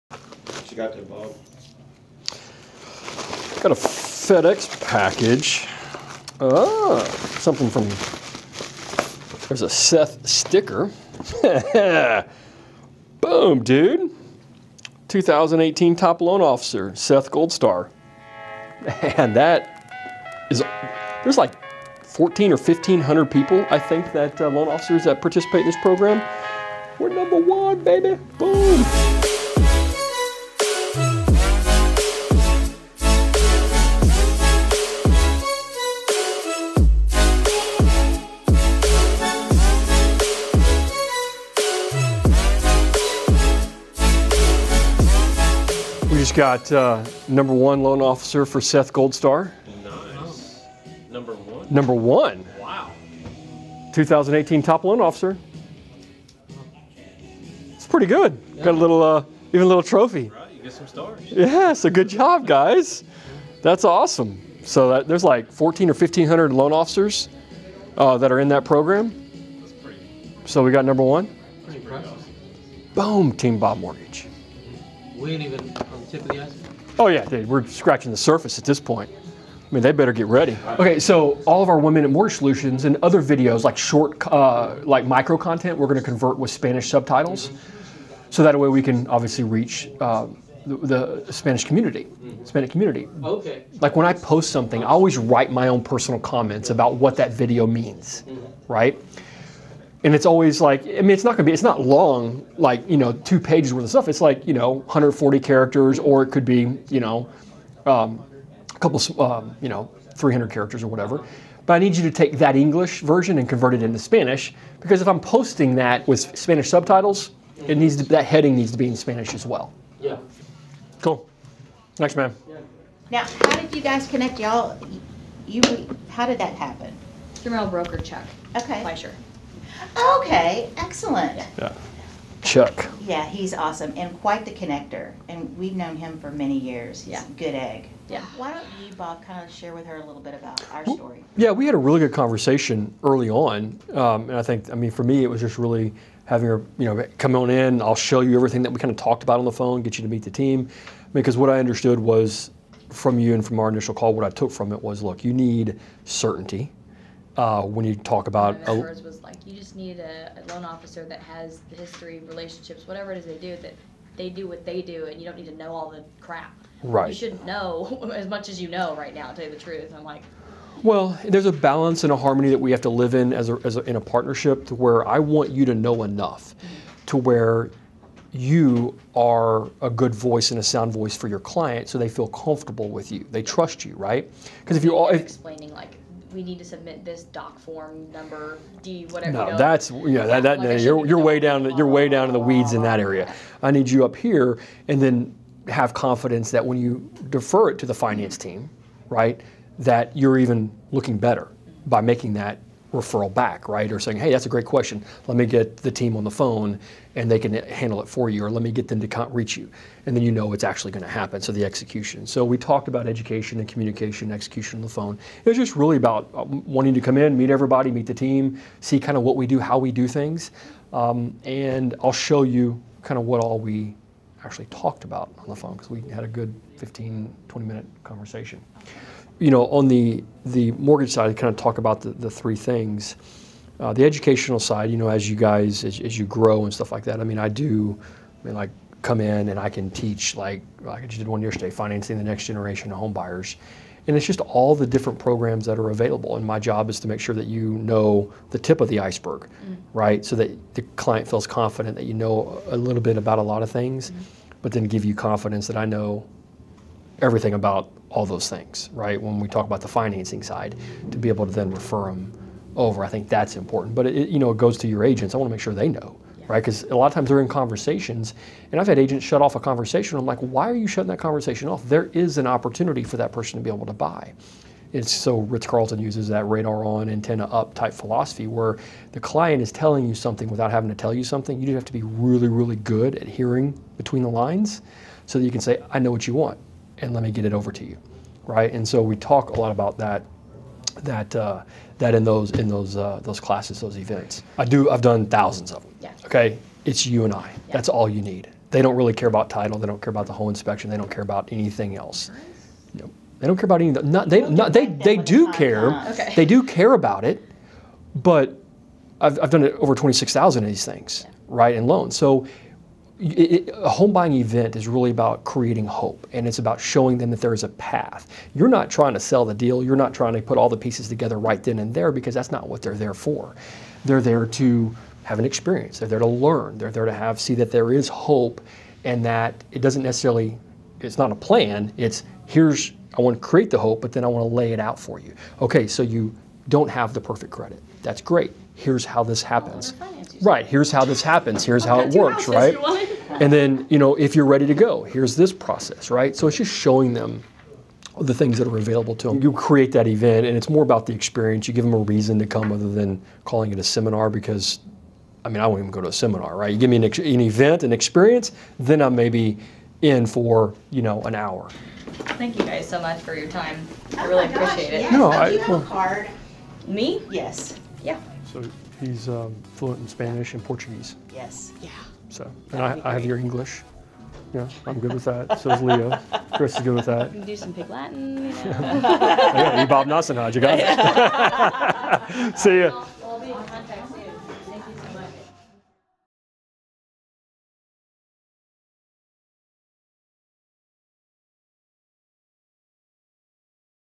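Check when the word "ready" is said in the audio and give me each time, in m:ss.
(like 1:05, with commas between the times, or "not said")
1:20, 5:44.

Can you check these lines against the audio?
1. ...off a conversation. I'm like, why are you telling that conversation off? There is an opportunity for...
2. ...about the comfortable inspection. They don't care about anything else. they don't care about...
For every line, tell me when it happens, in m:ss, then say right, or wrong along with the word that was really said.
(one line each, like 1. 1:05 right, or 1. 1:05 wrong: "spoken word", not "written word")
1. 4:29 wrong: "shutting", not "telling"
2. 5:00 wrong: "whole", not "comfortable".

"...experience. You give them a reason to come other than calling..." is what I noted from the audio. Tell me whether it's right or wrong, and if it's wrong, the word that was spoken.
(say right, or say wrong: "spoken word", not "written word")
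right.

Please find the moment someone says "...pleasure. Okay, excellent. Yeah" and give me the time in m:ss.
2:08.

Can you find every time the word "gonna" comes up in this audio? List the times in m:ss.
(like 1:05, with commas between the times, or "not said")
1:25, 1:41.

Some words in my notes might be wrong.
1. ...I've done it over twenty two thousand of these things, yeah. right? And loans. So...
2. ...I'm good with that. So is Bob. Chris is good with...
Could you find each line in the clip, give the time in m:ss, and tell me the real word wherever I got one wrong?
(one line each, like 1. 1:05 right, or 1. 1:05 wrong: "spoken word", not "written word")
1. 5:09 wrong: "six", not "two"
2. 6:14 wrong: "Leo", not "Bob".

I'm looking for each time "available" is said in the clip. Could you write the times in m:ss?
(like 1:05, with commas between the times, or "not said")
4:05, 5:48.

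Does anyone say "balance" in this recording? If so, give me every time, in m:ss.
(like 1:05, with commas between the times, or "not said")
2:51.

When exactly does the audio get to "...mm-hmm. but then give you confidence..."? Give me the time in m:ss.
4:14.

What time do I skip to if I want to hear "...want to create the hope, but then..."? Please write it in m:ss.
5:33.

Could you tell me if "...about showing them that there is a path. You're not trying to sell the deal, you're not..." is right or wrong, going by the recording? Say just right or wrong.
right.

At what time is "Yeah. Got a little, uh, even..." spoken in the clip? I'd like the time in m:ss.
0:58.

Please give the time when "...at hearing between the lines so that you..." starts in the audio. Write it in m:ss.
4:43.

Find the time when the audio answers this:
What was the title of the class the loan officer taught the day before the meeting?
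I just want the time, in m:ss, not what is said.
4:01.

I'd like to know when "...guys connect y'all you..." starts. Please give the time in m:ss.
2:03.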